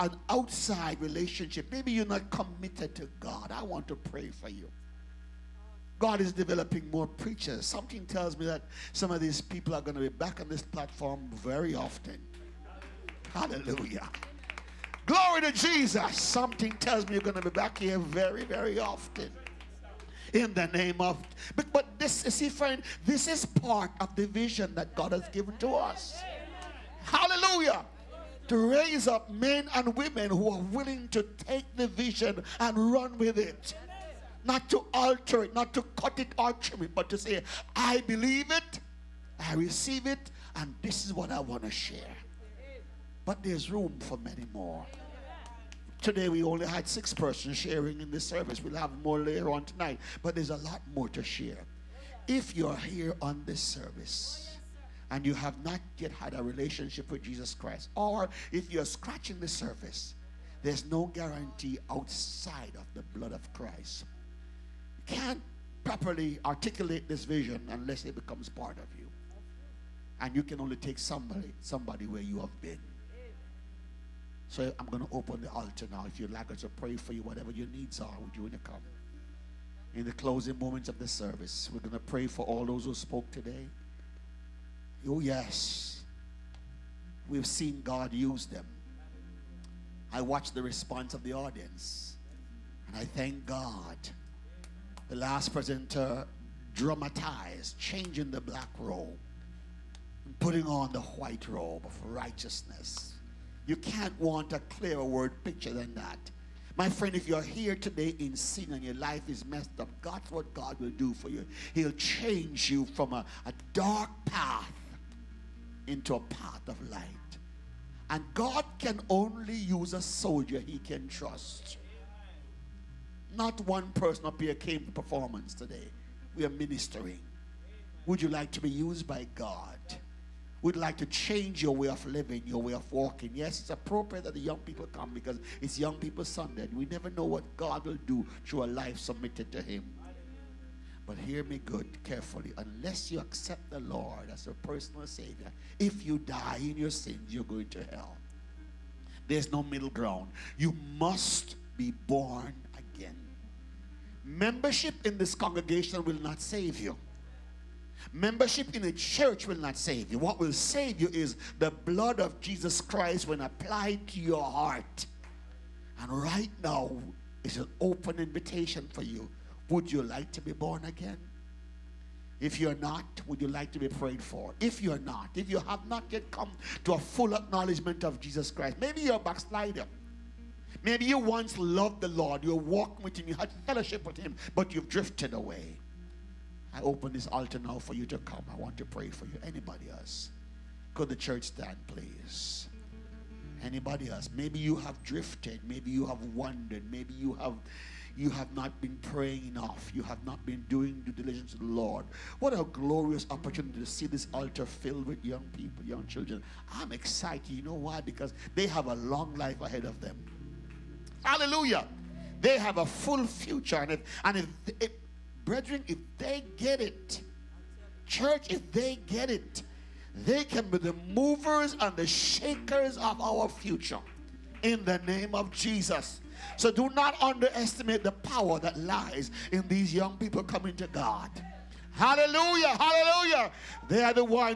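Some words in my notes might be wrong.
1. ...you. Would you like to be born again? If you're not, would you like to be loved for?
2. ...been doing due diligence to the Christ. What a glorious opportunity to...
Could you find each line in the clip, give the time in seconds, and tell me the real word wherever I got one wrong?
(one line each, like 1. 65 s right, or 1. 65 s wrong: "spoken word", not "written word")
1. 169 s wrong: "prayed", not "loved"
2. 200 s wrong: "Lord", not "Christ".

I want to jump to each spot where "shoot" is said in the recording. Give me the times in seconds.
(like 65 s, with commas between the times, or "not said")
not said.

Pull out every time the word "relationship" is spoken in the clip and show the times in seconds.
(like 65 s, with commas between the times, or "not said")
1 s, 56 s.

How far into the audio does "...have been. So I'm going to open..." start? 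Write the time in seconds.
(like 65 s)
72 s.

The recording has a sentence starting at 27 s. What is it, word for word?
Hallelujah to raise up men and women who are willing to take the vision and run with it.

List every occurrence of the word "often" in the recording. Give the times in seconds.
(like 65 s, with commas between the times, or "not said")
11 s, 18 s.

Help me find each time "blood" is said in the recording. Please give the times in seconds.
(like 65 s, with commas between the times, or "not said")
63 s, 161 s.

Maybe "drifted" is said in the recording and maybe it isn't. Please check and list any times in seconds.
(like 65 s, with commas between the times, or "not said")
184 s, 195 s.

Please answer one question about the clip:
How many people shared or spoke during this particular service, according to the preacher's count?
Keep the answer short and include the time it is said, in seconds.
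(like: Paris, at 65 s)
6, at 46 s.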